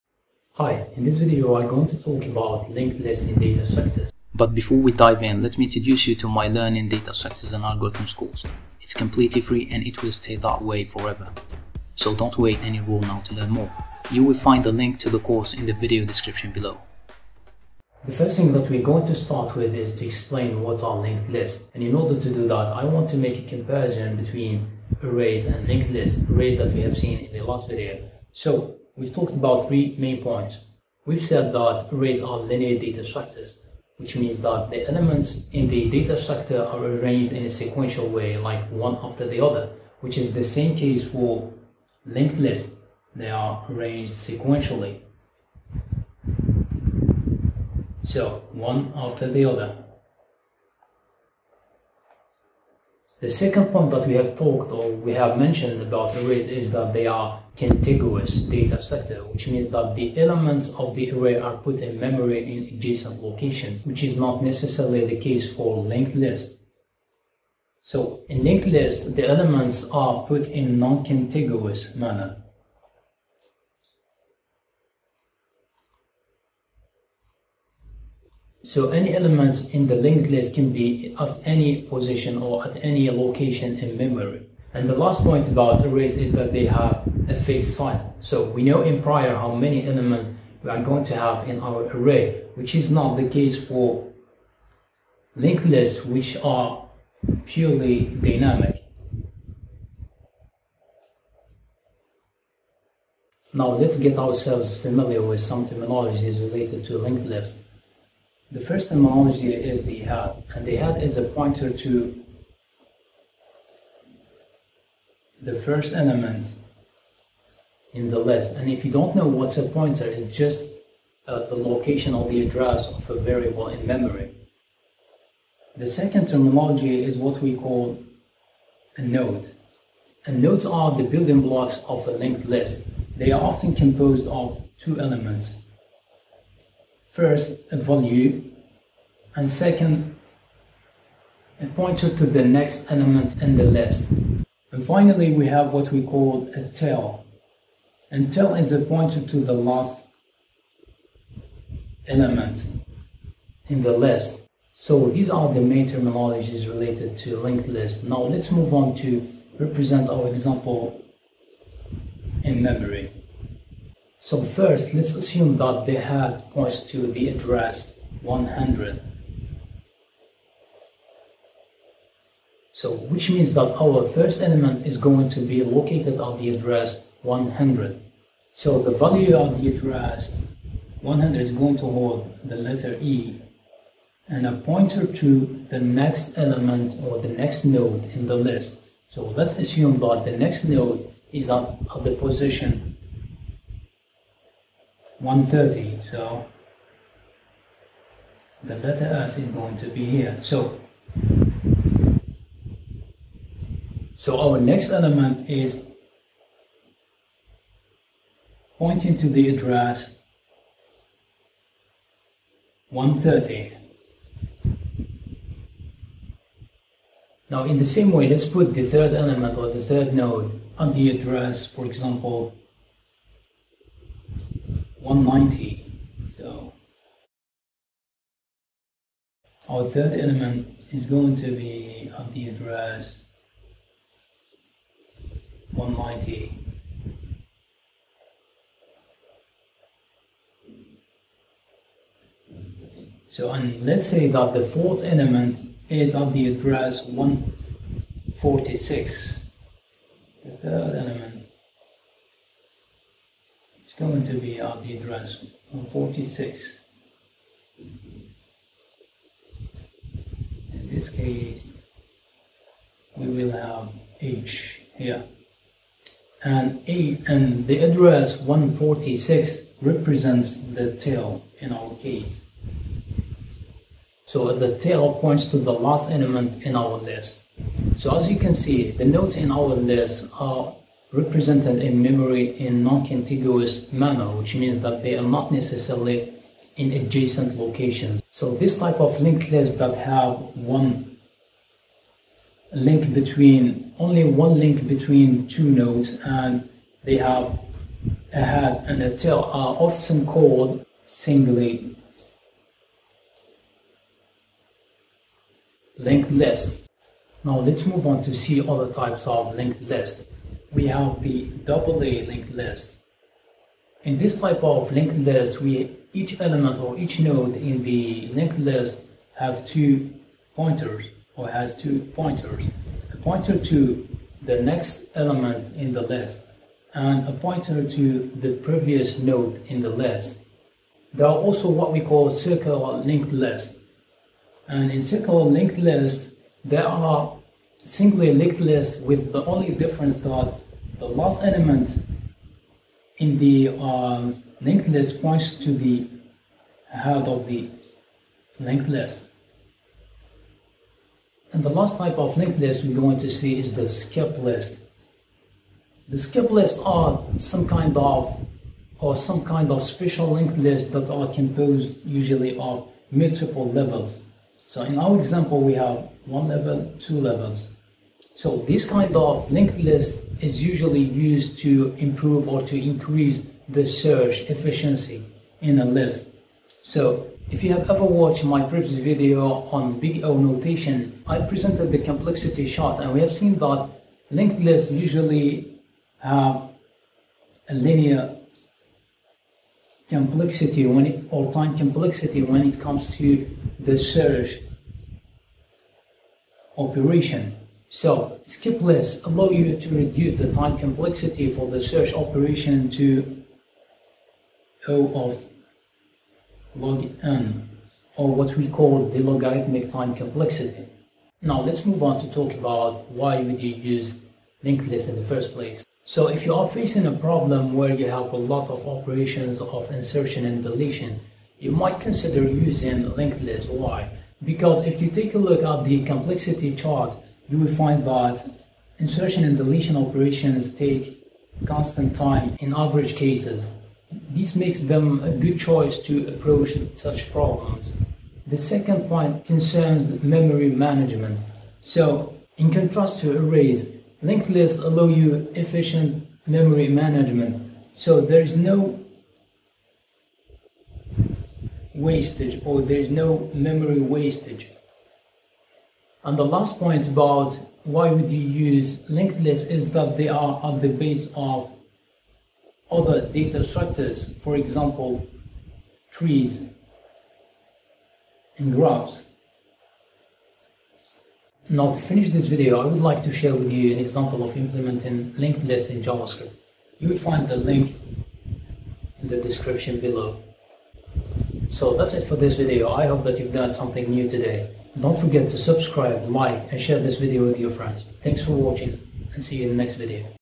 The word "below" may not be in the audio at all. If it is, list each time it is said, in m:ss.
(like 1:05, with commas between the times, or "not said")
0:16, 7:59.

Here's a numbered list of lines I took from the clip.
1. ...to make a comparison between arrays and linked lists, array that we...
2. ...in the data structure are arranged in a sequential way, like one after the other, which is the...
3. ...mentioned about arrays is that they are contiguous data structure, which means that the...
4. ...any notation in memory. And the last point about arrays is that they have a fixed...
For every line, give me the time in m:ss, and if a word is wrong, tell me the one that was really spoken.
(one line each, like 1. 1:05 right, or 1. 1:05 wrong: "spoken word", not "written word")
1. 0:23 right
2. 0:35 right
3. 0:55 right
4. 1:22 wrong: "location", not "notation".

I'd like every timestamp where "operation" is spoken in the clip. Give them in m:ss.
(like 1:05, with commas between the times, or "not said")
6:36, 6:42, 6:58, 7:09.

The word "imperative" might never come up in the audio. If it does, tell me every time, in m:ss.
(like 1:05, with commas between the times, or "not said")
not said.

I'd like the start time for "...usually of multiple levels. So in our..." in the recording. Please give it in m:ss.
6:02.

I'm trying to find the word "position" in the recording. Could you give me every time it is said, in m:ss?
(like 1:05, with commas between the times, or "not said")
1:21, 3:12.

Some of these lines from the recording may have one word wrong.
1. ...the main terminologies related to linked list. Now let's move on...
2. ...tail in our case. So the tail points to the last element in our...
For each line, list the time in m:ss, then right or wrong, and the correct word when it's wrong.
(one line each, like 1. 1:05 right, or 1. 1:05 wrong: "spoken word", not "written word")
1. 2:35 right
2. 4:30 right.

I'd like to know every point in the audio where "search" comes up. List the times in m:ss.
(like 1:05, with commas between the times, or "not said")
6:13, 6:33, 6:41.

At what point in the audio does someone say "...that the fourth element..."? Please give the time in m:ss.
4:04.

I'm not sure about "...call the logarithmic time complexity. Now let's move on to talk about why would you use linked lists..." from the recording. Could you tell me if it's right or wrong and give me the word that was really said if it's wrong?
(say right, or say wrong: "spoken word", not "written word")
right.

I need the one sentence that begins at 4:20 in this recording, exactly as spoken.
In this case, we will have H here.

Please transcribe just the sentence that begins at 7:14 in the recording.
This makes them a good choice to approach such problems.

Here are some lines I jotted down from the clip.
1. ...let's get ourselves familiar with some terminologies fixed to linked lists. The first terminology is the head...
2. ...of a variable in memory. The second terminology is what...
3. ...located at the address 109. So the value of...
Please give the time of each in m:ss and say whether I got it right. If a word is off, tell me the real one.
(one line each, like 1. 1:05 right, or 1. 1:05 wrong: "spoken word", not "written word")
1. 1:43 wrong: "related", not "fixed"
2. 2:02 right
3. 2:55 wrong: "100", not "109".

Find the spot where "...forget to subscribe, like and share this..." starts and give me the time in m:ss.
8:05.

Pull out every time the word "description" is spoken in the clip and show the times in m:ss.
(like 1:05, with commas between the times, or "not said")
0:16, 7:59.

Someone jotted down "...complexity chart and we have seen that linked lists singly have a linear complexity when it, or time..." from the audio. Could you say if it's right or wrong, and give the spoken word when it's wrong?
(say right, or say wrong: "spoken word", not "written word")
wrong: "usually", not "singly".